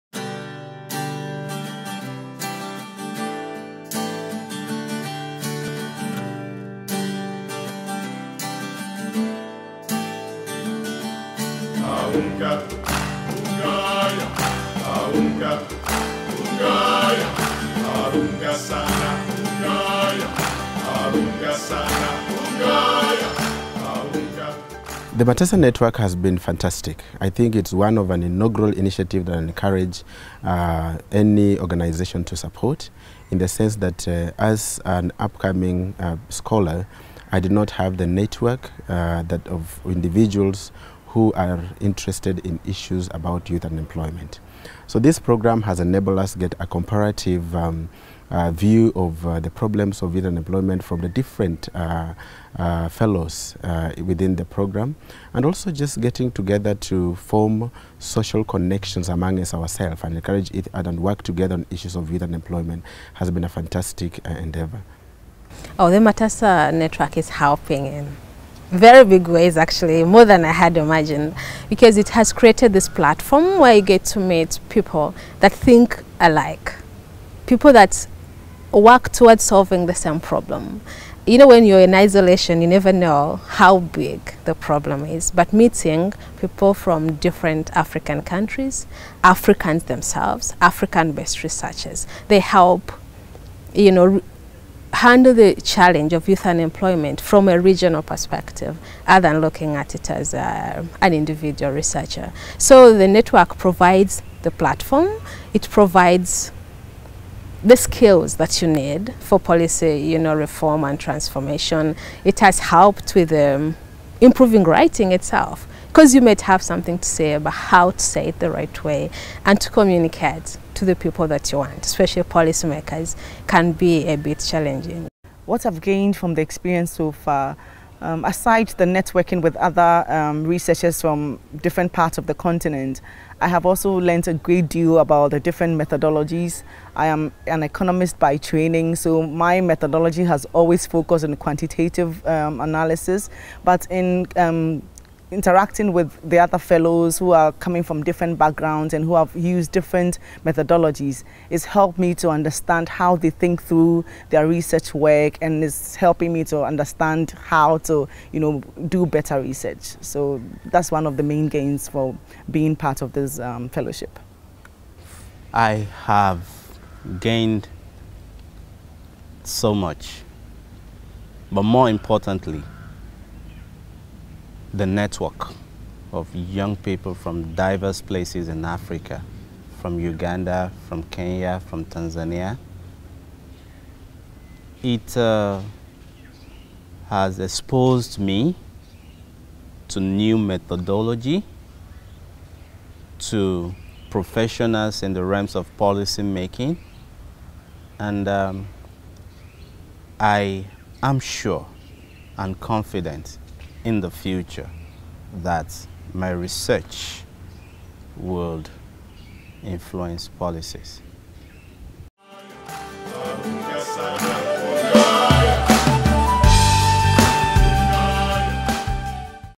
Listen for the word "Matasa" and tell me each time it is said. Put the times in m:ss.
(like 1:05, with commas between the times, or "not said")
0:25, 1:06.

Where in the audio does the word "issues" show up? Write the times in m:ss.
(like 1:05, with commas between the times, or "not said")
0:42, 1:01.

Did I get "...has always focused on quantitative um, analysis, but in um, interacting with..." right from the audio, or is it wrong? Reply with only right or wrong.
right.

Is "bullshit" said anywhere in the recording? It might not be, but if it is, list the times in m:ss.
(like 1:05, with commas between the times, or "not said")
not said.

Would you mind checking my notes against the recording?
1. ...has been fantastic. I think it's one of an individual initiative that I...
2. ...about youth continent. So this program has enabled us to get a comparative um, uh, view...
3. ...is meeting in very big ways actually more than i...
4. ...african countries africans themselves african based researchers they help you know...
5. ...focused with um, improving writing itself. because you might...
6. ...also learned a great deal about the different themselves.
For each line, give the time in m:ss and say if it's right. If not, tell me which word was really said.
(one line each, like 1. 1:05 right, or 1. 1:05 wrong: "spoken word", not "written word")
1. 0:25 wrong: "inaugural", not "individual"
2. 0:43 wrong: "unemployment", not "continent"
3. 1:07 wrong: "helping", not "meeting"
4. 1:27 right
5. 1:52 wrong: "helped", not "focused"
6. 2:13 wrong: "methodologies", not "themselves".